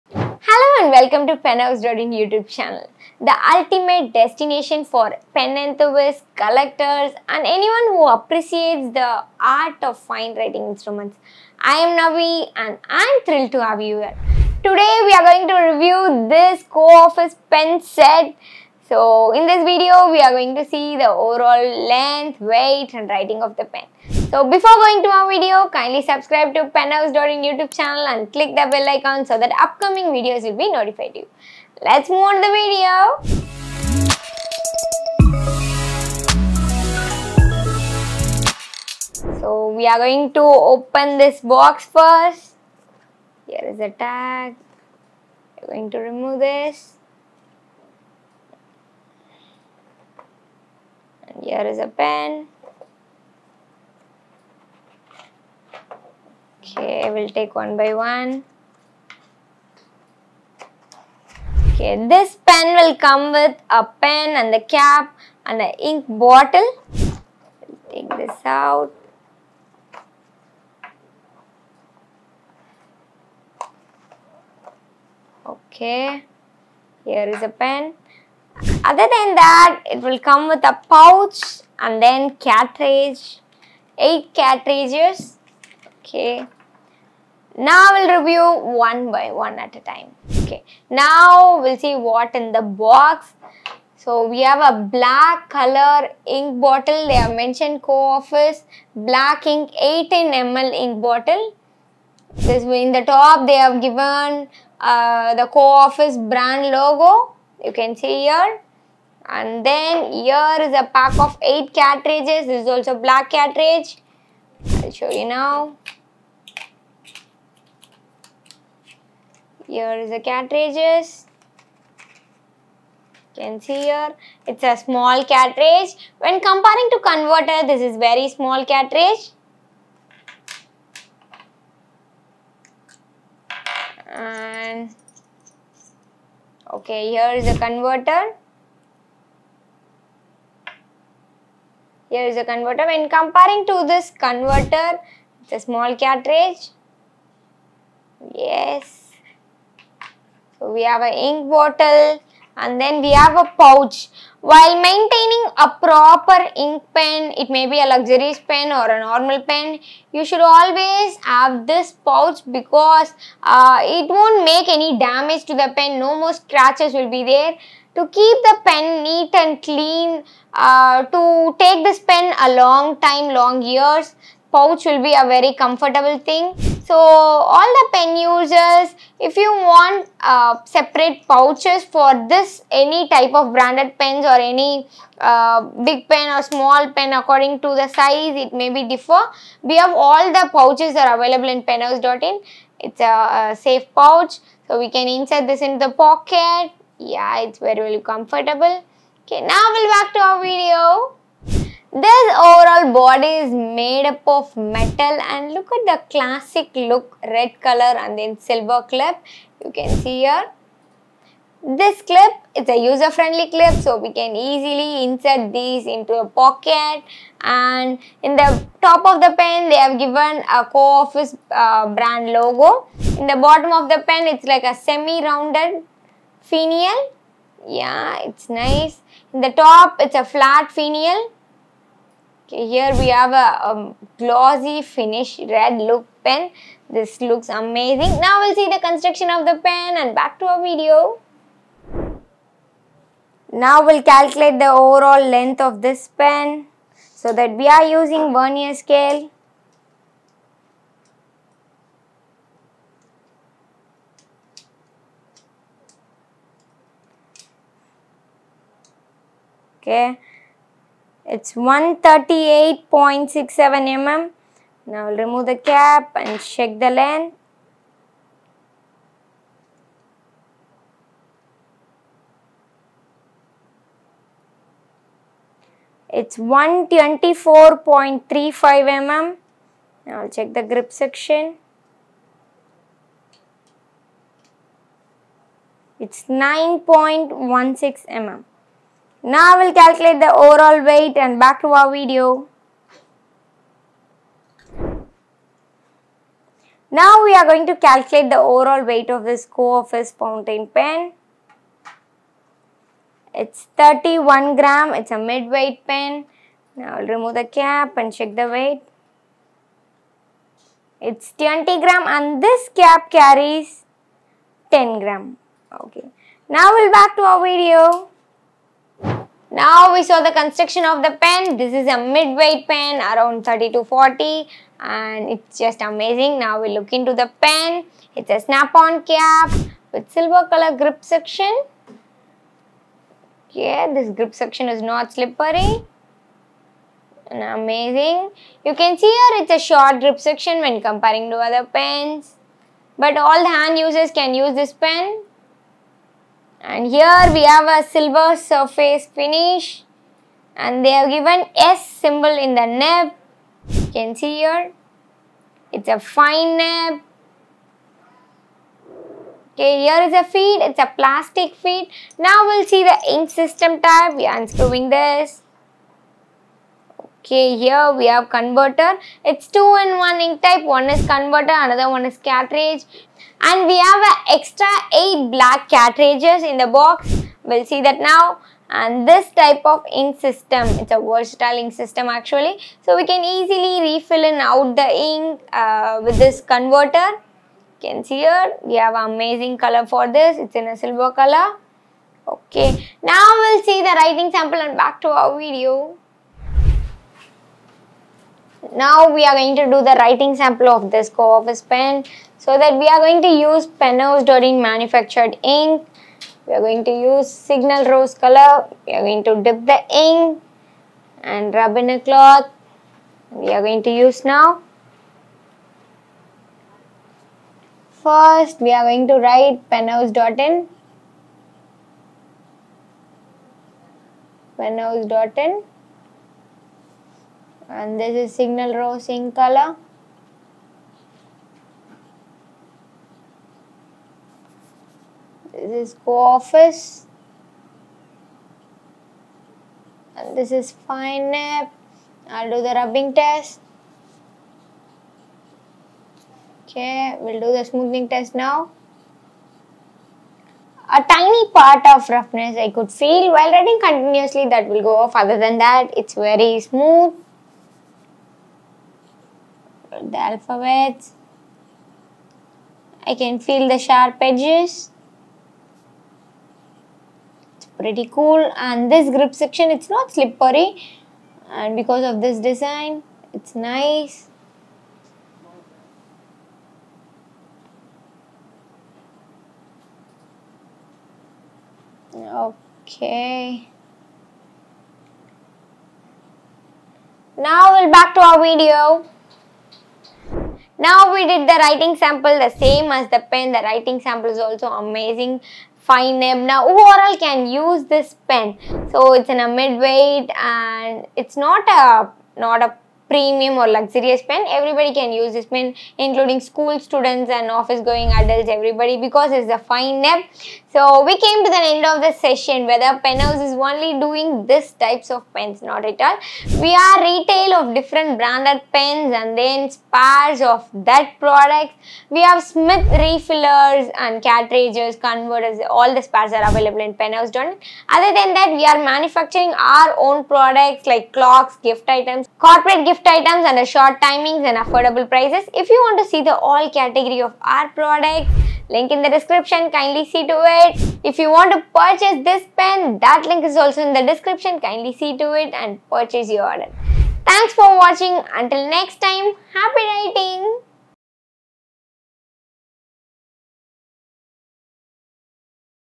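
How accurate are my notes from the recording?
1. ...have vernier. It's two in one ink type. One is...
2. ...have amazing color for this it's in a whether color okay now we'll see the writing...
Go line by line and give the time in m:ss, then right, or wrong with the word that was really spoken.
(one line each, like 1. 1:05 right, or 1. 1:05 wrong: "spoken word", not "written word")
1. 6:08 wrong: "converter", not "vernier"
2. 6:28 wrong: "silver", not "whether".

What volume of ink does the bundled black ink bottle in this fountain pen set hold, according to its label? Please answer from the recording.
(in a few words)
18 ml.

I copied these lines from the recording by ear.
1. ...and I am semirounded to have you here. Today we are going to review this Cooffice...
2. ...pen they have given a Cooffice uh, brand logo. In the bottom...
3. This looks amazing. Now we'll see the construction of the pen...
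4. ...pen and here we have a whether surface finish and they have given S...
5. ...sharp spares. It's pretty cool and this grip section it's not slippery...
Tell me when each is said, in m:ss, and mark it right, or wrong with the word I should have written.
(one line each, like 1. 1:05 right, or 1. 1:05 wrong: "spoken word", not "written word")
1. 0:12 wrong: "thrilled", not "semirounded"
2. 3:39 right
3. 3:56 right
4. 5:44 wrong: "silver", not "whether"
5. 7:43 wrong: "edges", not "spares".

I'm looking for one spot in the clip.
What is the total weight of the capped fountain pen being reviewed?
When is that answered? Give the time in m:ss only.
5:03.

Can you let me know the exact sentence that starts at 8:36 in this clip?
We are retail of different branded pens and then spares of that product.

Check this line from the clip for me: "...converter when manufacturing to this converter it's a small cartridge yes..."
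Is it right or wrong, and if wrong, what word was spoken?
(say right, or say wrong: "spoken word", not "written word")
wrong: "comparing", not "manufacturing".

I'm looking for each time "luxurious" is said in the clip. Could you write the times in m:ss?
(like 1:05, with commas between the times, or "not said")
2:37, 8:23.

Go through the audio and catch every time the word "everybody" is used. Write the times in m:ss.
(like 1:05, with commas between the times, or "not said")
8:24, 8:28.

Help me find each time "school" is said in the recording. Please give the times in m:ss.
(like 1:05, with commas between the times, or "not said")
8:26.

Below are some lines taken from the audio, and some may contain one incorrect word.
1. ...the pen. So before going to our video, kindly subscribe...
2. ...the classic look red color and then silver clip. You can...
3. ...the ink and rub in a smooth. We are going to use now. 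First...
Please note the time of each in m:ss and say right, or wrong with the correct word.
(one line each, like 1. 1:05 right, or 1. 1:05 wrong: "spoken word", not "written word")
1. 0:23 right
2. 3:25 right
3. 6:49 wrong: "cloth", not "smooth".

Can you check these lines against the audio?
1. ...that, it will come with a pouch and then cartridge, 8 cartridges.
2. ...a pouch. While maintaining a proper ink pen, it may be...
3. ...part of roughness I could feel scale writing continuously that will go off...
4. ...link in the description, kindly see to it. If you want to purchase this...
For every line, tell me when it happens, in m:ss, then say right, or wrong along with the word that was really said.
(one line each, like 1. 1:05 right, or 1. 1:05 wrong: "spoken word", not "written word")
1. 1:19 right
2. 2:33 right
3. 7:31 wrong: "while", not "scale"
4. 8:58 right.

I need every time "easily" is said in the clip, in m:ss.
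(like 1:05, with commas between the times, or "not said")
3:34, 6:23.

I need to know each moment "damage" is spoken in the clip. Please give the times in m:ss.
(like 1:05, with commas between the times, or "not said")
2:44.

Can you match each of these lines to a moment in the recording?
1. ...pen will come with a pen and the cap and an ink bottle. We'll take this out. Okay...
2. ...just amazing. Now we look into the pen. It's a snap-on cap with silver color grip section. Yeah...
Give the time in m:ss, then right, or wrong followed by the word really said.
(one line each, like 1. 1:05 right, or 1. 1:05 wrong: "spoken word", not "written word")
1. 1:02 right
2. 5:25 right.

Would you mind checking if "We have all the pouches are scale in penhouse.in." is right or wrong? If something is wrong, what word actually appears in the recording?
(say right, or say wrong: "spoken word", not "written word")
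wrong: "available", not "scale".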